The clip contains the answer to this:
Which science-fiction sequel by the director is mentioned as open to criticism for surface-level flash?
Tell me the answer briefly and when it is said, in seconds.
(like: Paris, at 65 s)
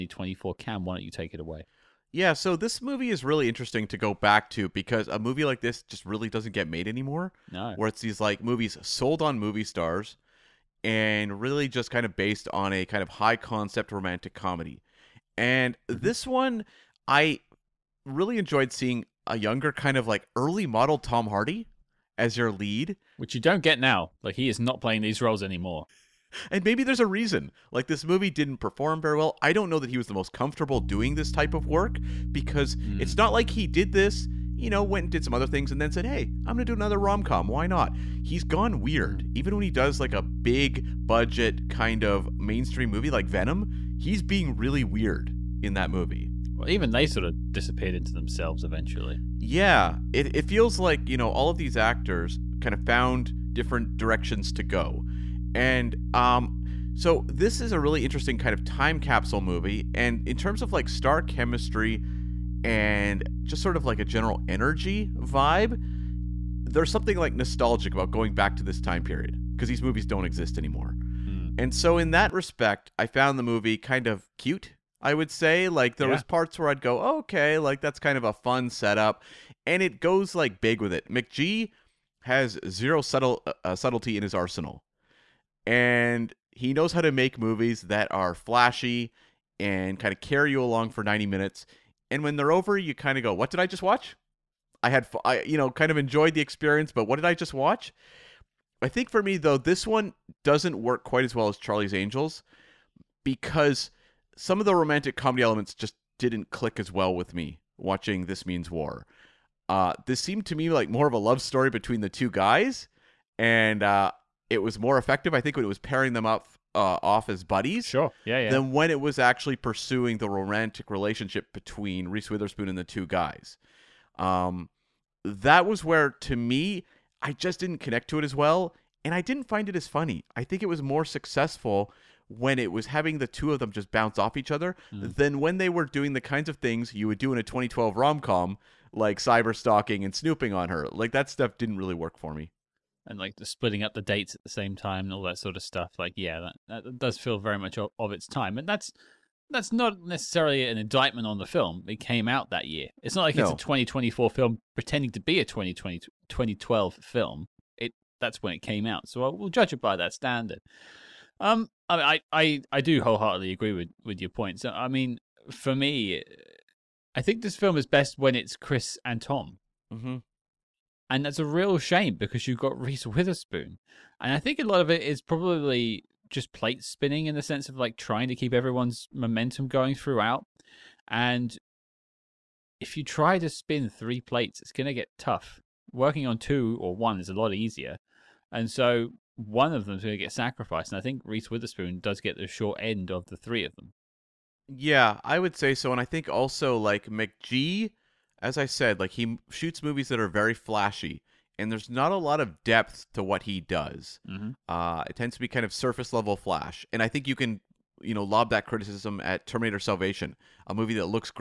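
Terminator Salvation, at 209 s.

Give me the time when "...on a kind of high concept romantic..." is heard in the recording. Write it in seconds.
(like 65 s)
12 s.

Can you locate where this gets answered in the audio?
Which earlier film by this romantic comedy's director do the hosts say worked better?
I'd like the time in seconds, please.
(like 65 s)
101 s.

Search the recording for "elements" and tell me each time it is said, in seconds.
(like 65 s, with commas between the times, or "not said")
105 s.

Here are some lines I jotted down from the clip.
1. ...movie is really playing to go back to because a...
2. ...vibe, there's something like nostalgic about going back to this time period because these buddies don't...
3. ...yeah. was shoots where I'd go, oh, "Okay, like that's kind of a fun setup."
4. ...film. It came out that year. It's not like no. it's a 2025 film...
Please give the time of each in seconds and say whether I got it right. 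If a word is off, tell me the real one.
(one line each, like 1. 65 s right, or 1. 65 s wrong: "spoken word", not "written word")
1. 2 s wrong: "interesting", not "playing"
2. 65 s wrong: "movies", not "buddies"
3. 76 s wrong: "parts", not "shoots"
4. 151 s wrong: "2024", not "2025".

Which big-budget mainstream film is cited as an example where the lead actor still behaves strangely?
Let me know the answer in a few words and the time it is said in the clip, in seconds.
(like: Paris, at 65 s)
Venom, at 43 s.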